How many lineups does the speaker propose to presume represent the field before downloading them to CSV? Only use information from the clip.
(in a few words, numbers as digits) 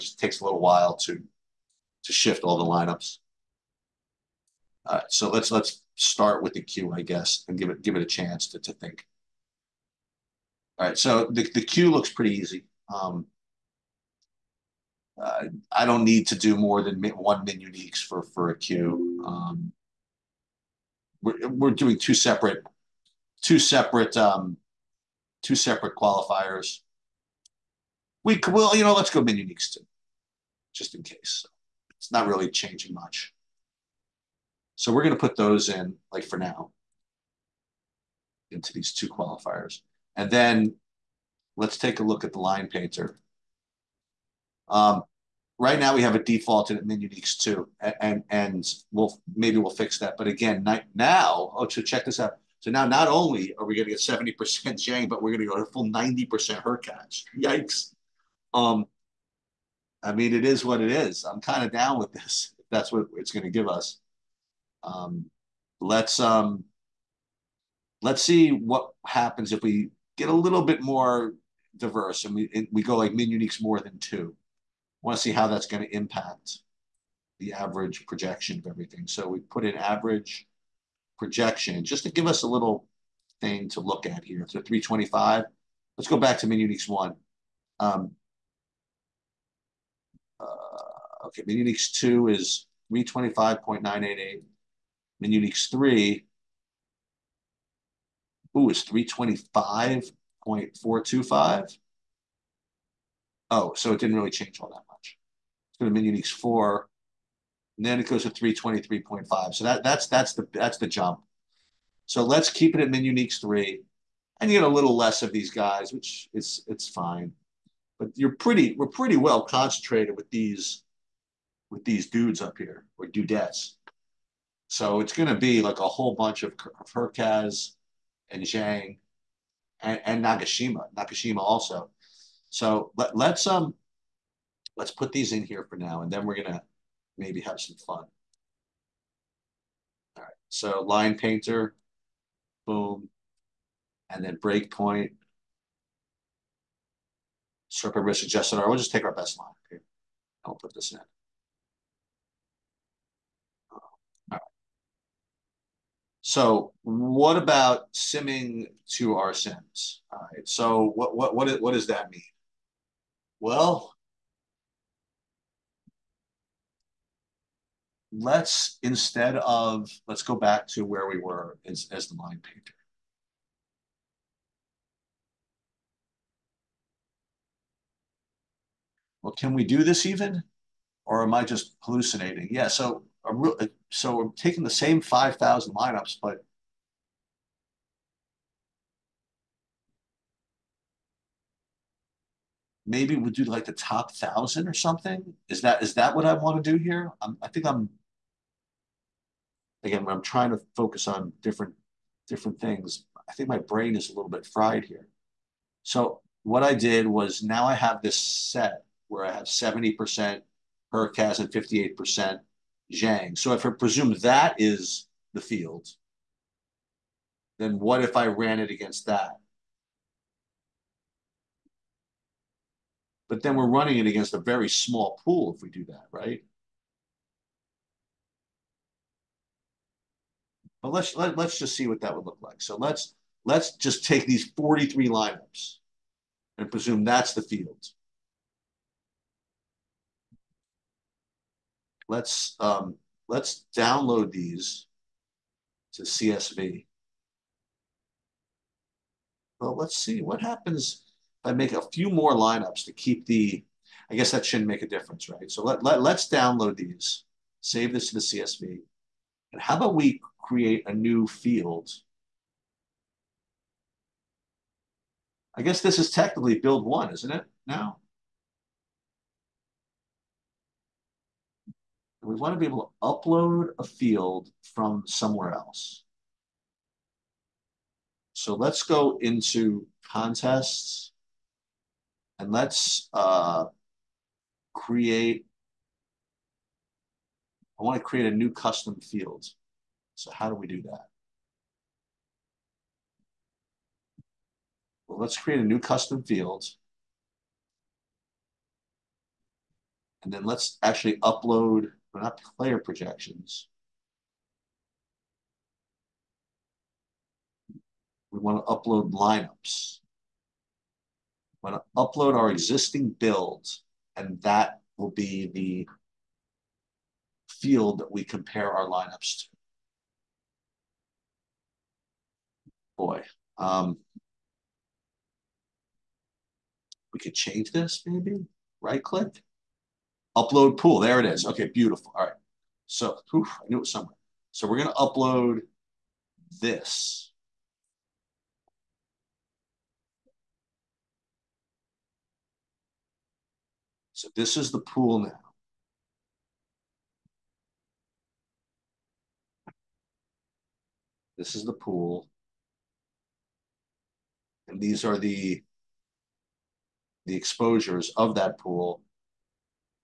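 43.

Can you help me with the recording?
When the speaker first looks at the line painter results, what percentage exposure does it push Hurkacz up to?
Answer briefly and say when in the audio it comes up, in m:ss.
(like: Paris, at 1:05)
90%, at 0:55.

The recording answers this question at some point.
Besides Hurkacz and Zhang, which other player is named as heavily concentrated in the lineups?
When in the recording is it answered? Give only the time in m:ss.
2:10.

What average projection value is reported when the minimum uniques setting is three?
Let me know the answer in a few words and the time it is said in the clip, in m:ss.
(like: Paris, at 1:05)
325.425, at 1:38.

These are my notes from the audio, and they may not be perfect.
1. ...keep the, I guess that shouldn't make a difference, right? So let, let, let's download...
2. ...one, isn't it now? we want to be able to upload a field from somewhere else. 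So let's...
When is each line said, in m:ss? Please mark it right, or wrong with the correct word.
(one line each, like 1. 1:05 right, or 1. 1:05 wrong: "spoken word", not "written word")
1. 4:12 right
2. 4:26 right.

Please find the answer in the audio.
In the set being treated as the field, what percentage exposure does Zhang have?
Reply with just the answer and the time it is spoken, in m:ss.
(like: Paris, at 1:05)
58%, at 3:31.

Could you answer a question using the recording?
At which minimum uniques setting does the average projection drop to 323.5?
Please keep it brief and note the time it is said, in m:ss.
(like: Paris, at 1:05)
4, at 1:46.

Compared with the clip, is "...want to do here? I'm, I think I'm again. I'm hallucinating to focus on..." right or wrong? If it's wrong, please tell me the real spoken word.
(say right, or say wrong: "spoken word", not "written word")
wrong: "trying", not "hallucinating".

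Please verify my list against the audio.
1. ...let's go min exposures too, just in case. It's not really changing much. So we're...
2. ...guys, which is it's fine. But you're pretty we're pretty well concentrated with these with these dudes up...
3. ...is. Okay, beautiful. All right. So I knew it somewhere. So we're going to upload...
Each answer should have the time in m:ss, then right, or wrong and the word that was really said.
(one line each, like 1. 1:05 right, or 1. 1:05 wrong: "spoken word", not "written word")
1. 0:28 wrong: "uniques", not "exposures"
2. 1:55 right
3. 5:31 right.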